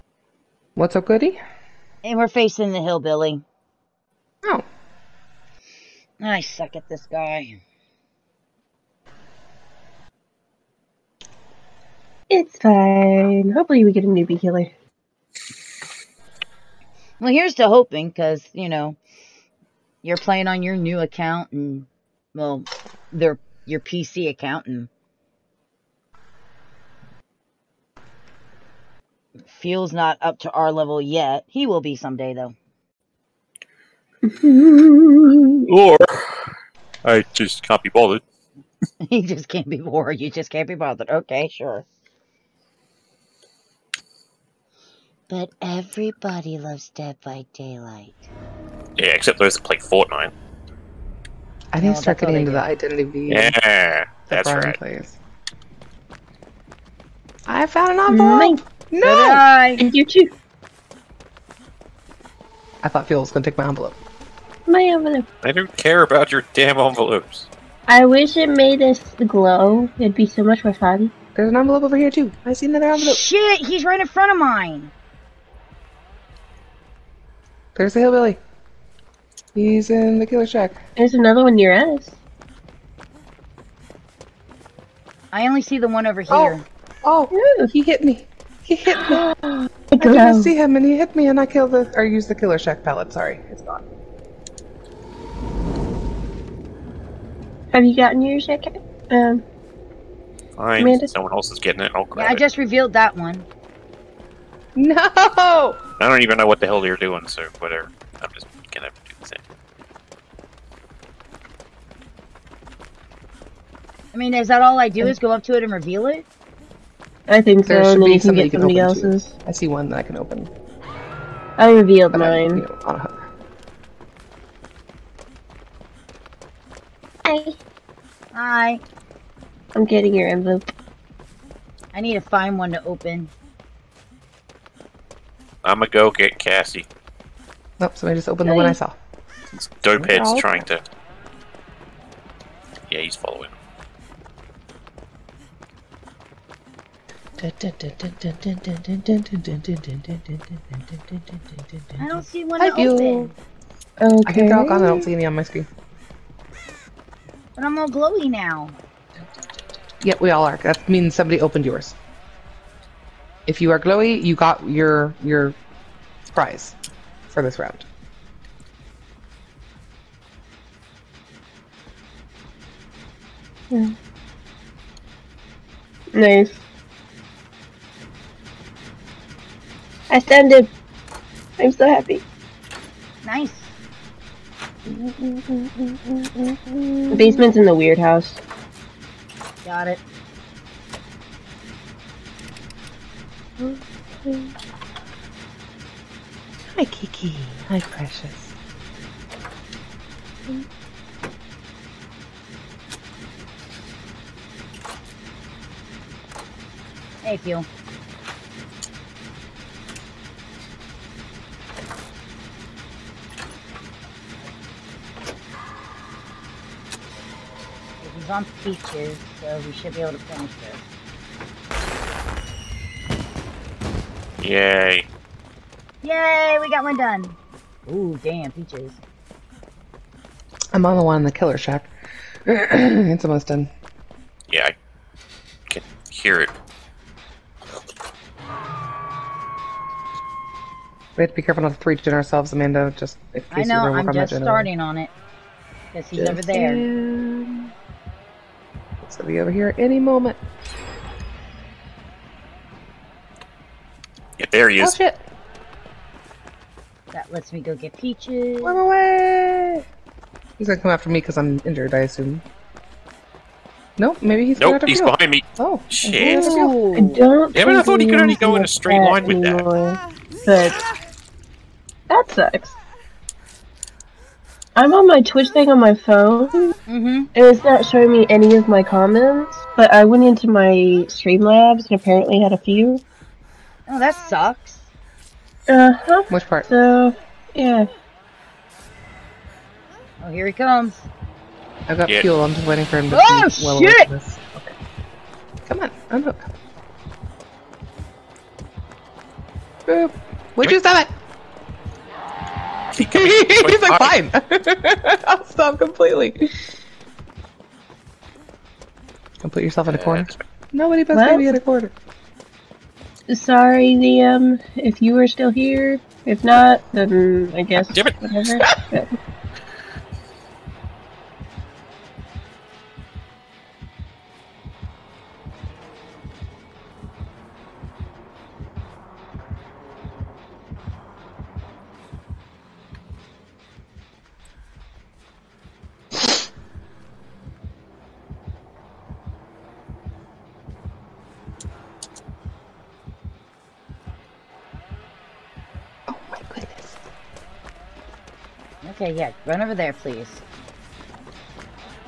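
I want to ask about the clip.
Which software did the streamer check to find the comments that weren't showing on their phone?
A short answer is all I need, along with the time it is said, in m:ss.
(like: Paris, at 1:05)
Streamlabs, at 4:41.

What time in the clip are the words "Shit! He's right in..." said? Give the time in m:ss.
1:13.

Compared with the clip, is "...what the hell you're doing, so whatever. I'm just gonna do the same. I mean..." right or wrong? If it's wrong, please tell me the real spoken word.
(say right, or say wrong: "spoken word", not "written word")
right.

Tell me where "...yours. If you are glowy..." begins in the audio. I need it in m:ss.
2:41.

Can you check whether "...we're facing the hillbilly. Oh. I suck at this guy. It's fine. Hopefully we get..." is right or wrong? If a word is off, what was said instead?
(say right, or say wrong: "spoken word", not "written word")
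right.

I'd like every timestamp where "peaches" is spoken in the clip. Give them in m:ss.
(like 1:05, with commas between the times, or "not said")
3:38, 3:48, 4:17.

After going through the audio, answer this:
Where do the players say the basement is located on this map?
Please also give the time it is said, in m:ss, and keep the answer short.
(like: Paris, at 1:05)
In the weird house, at 3:07.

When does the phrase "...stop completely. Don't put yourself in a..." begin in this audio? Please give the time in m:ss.
5:05.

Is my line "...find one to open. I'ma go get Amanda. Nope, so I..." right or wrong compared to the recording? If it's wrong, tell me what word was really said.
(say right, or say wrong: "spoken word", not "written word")
wrong: "Cassie", not "Amanda".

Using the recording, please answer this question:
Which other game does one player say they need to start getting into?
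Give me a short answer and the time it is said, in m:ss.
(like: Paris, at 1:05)
Identity V, at 0:52.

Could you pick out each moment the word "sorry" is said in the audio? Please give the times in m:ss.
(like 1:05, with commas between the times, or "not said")
1:33, 5:13.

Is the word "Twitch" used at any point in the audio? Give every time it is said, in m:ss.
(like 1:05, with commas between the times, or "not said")
4:35.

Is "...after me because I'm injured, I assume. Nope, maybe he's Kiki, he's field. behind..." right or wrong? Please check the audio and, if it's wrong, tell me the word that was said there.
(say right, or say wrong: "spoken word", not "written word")
wrong: "Nope", not "Kiki".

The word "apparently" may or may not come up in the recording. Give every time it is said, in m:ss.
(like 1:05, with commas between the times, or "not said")
4:41.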